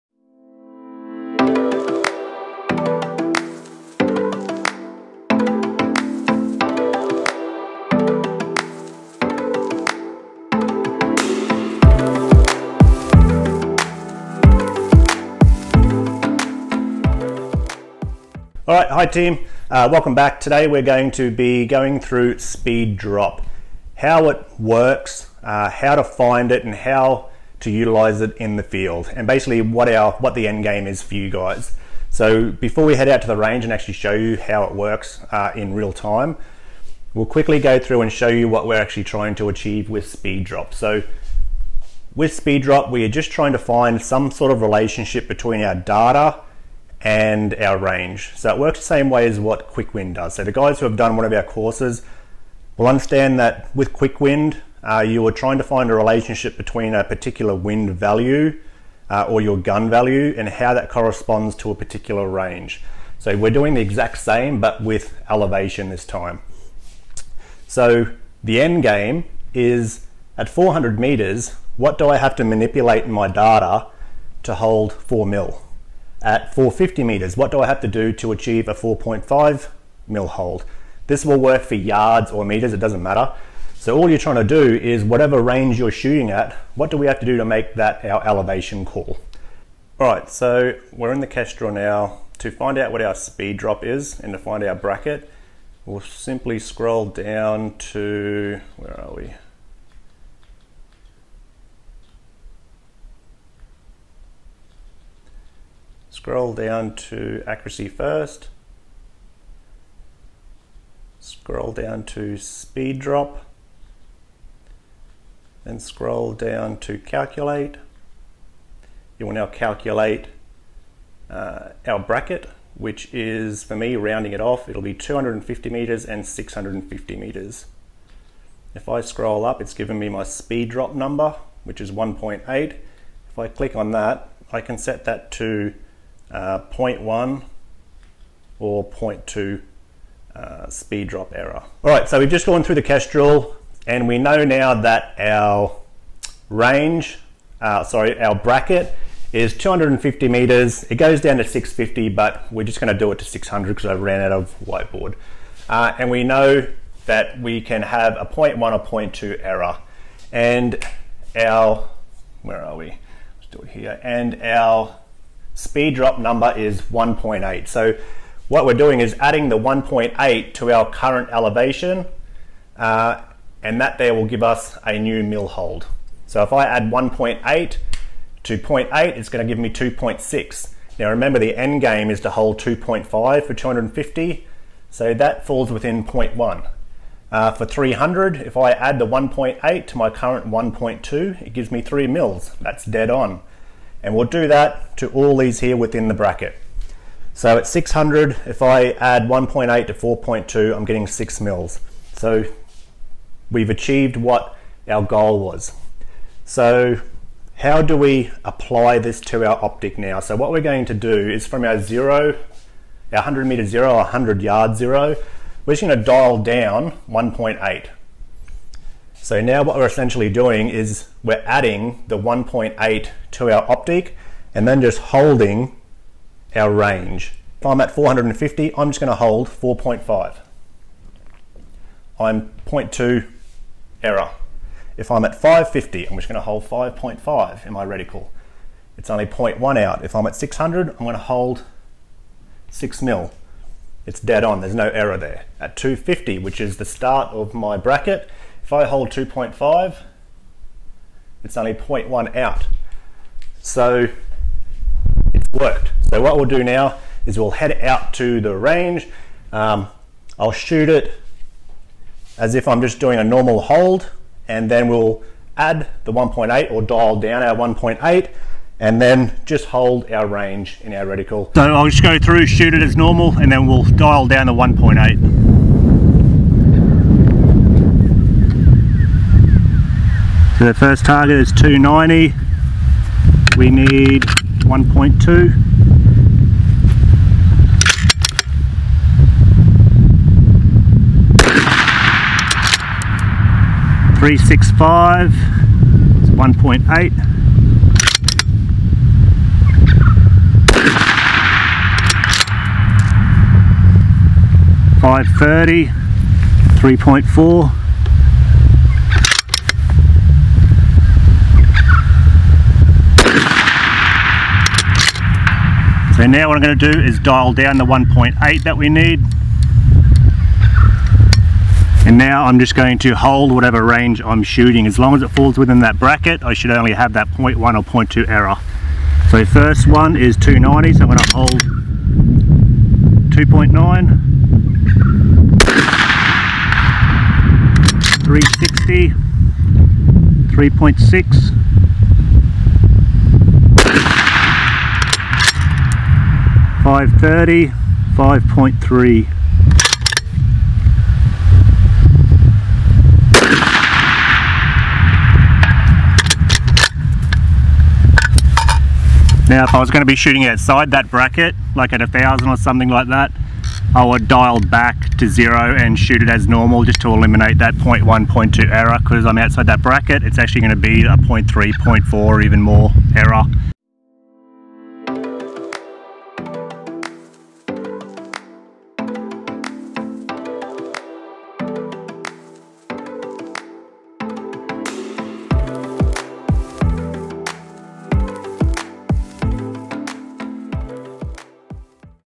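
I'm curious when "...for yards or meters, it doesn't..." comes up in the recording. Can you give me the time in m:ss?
1:21.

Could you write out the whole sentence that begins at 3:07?
Uh, for 300, if I add the 1.8 to my current 1.2, it gives me three mils.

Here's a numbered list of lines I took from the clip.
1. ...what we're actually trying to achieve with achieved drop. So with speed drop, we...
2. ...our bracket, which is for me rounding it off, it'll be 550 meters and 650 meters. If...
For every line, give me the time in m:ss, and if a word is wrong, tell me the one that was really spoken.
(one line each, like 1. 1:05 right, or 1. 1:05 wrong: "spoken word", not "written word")
1. 0:38 wrong: "speed", not "achieved"
2. 2:01 wrong: "250", not "550".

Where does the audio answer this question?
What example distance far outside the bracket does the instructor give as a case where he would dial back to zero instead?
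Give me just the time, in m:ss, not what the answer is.
6:02.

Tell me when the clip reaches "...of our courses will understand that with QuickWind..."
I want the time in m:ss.
0:51.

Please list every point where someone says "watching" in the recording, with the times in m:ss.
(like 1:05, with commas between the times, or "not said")
not said.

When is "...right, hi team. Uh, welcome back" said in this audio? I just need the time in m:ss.
0:18.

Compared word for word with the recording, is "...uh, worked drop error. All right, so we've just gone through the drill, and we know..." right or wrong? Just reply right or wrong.
wrong.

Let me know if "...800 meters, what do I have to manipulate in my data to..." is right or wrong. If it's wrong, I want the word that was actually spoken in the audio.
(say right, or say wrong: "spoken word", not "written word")
wrong: "400", not "800".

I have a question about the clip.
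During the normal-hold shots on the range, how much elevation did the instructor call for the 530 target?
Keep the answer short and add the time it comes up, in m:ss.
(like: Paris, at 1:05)
3.4, at 5:06.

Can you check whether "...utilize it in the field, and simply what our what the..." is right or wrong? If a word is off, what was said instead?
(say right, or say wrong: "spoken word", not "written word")
wrong: "basically", not "simply".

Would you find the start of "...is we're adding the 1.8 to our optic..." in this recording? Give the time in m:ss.
3:40.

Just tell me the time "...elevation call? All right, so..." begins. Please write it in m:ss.
1:28.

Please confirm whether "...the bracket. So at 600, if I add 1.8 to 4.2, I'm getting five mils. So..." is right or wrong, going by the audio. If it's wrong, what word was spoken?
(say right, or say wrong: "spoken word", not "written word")
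wrong: "six", not "five".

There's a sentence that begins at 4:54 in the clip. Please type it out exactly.
Three six five, one point eight.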